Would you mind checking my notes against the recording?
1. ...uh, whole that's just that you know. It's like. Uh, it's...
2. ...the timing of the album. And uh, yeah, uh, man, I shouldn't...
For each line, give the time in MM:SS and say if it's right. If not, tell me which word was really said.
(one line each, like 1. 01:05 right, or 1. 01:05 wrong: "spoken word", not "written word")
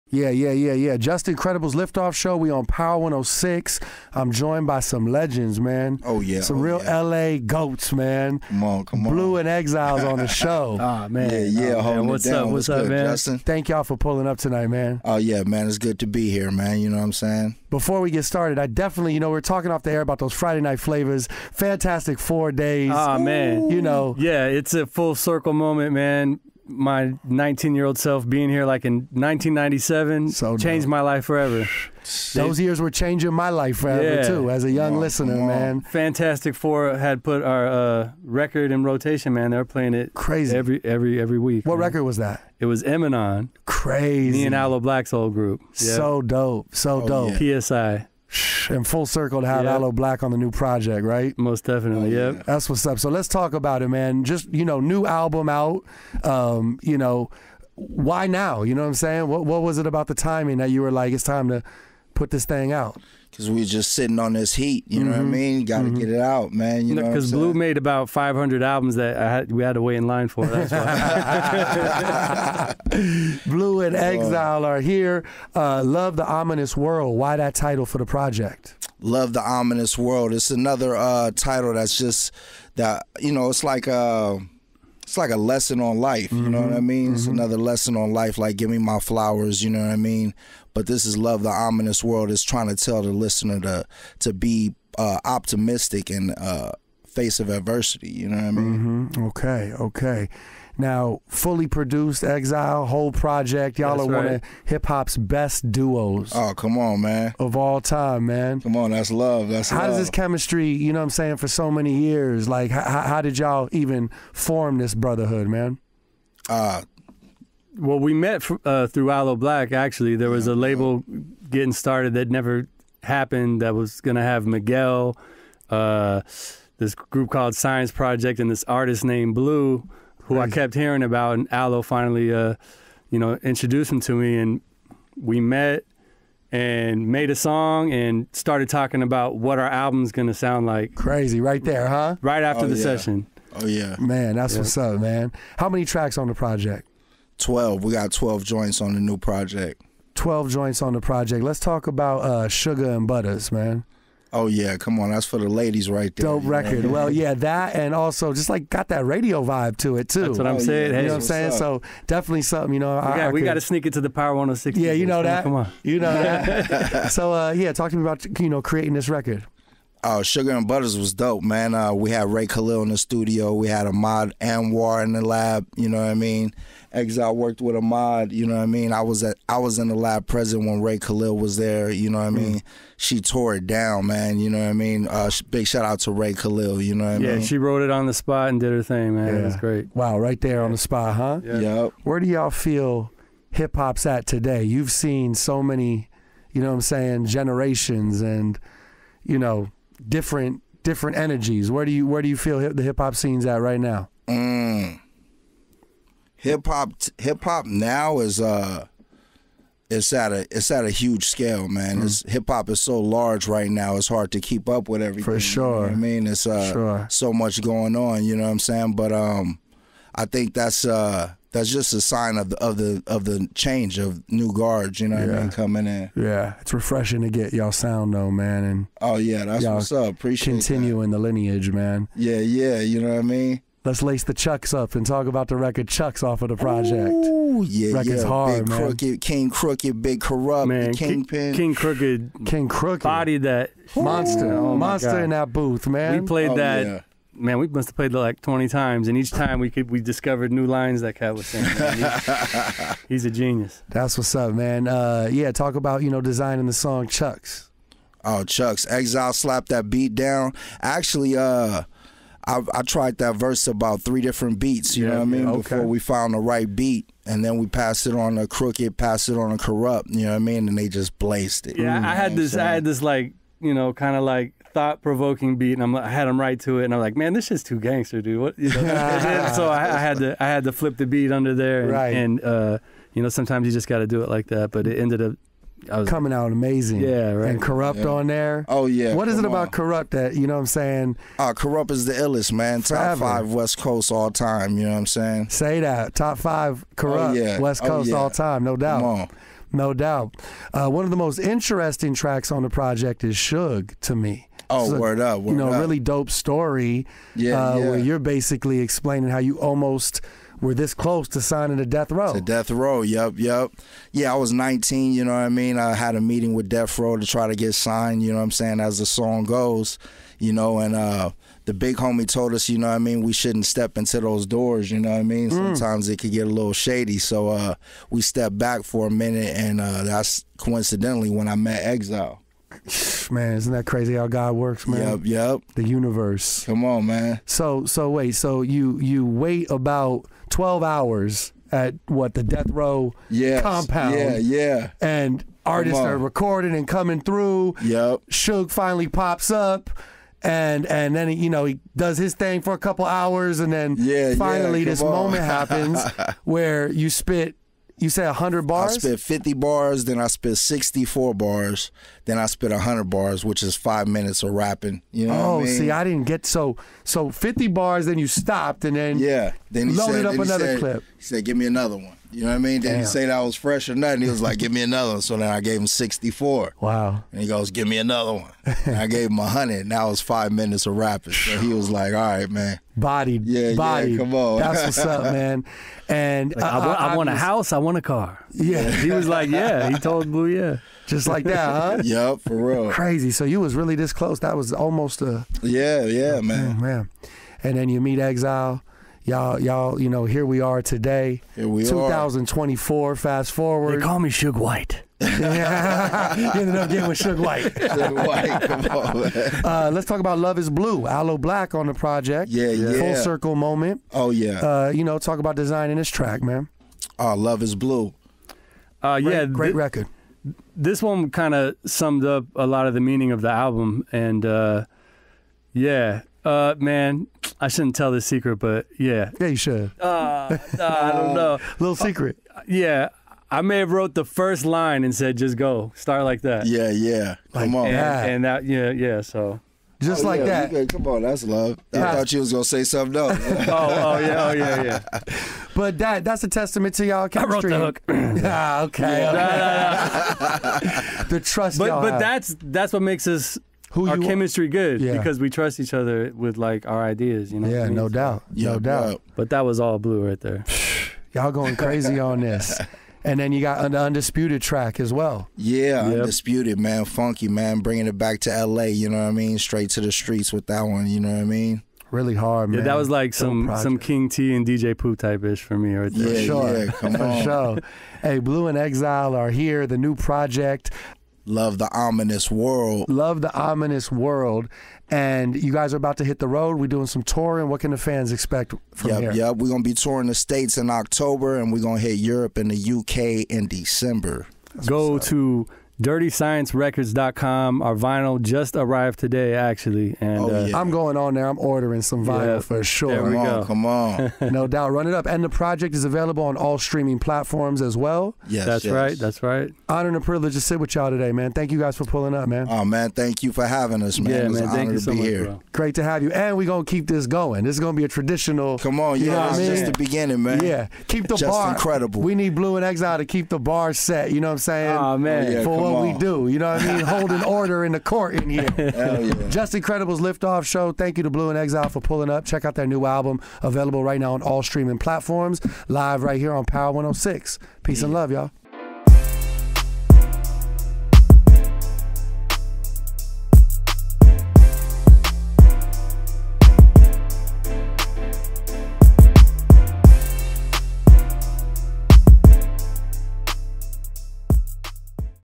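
1. 01:20 wrong: "title", not "whole"
2. 07:02 wrong: "meaning", not "timing".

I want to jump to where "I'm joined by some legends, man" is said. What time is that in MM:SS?
00:04.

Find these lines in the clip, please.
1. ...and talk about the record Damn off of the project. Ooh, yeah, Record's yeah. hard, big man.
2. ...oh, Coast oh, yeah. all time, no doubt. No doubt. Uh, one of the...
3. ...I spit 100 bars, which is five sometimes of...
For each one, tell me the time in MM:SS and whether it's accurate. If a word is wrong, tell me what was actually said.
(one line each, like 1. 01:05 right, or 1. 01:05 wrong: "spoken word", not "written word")
1. 03:54 wrong: "Chucks", not "Damn"
2. 04:57 right
3. 06:02 wrong: "minutes", not "sometimes".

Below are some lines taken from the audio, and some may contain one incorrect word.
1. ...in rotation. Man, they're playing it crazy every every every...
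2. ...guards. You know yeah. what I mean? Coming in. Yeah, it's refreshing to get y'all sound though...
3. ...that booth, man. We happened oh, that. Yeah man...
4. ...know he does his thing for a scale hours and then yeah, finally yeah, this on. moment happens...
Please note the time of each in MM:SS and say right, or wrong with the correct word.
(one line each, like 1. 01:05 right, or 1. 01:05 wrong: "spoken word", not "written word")
1. 00:38 right
2. 03:44 right
3. 04:05 wrong: "played", not "happened"
4. 05:51 wrong: "couple", not "scale".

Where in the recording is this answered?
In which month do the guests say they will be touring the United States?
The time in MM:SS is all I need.
08:10.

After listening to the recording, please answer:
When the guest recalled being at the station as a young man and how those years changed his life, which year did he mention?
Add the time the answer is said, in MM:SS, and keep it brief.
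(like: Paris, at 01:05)
1997, at 00:29.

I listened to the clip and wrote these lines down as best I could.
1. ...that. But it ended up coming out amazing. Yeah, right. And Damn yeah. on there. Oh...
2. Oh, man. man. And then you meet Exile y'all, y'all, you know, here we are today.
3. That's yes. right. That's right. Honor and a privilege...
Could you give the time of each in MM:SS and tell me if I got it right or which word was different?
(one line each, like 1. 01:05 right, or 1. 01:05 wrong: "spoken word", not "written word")
1. 04:44 wrong: "Kurupt", not "Damn"
2. 06:36 right
3. 08:28 right.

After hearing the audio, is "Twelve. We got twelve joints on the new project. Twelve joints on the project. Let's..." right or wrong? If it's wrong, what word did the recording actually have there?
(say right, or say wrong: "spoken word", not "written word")
right.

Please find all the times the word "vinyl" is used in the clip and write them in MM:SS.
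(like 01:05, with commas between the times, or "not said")
08:17, 08:22.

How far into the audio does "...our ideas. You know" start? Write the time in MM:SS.
07:36.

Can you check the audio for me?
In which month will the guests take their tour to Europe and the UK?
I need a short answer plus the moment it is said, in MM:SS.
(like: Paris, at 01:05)
December, at 08:13.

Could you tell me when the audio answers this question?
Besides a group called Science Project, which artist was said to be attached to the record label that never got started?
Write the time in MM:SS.
02:04.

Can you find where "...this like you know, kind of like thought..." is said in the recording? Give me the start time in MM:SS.
04:32.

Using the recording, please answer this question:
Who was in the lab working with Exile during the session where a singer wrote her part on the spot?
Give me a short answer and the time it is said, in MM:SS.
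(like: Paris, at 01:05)
Ahmad Anwar, at 02:53.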